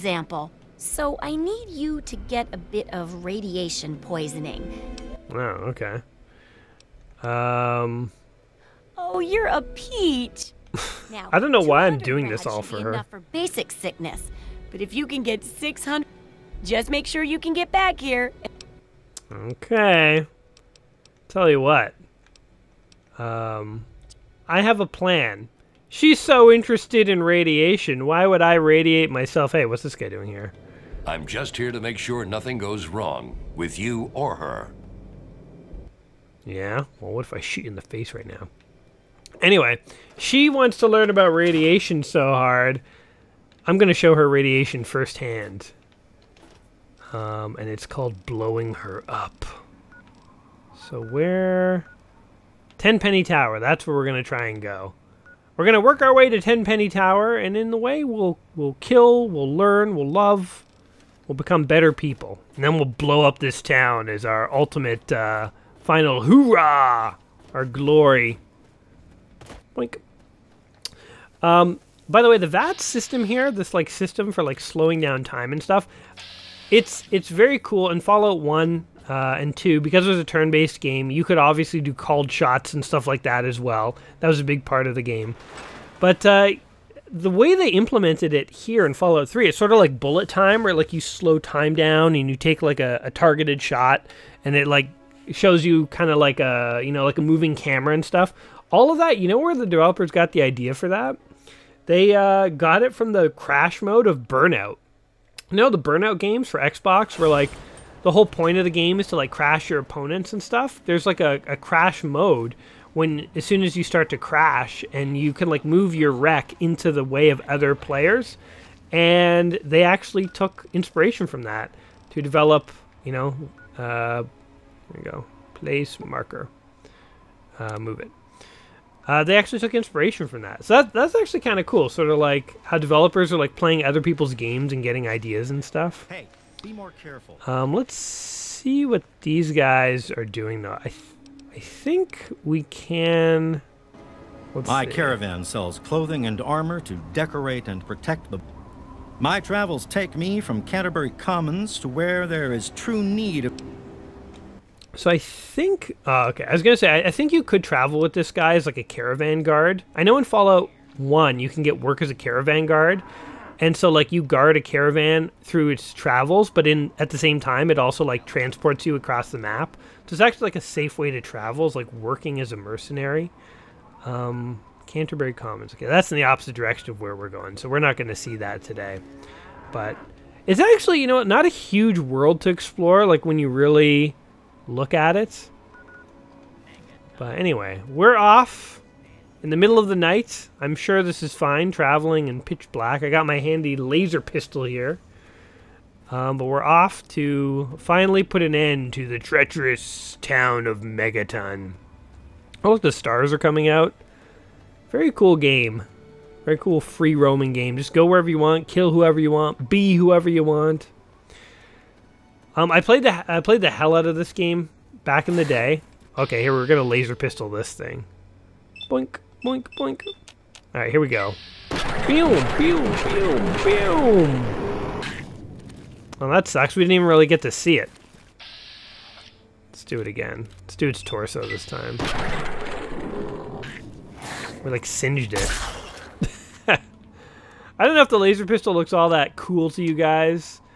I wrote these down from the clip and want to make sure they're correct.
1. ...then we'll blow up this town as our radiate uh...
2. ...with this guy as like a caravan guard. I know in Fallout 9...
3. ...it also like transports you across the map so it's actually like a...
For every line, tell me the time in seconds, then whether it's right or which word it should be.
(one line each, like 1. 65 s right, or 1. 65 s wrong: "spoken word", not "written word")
1. 62 s wrong: "ultimate", not "radiate"
2. 157 s wrong: "1", not "9"
3. 167 s right.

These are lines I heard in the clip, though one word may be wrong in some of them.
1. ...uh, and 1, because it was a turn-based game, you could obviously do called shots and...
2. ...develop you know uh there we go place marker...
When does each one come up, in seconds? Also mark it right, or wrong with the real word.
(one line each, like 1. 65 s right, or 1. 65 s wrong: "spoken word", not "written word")
1. 79 s wrong: "2", not "1"
2. 122 s right.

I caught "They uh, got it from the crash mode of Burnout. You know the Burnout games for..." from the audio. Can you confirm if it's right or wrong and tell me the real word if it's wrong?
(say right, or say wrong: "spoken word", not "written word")
right.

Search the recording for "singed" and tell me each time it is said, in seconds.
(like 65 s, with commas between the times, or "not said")
234 s.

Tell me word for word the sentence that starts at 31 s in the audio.
I'm just here to make sure nothing goes wrong with you or her.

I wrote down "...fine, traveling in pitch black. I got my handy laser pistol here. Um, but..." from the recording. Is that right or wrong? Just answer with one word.
right.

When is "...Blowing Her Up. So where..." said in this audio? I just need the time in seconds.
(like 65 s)
48 s.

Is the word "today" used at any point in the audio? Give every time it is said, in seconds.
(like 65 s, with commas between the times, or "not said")
178 s.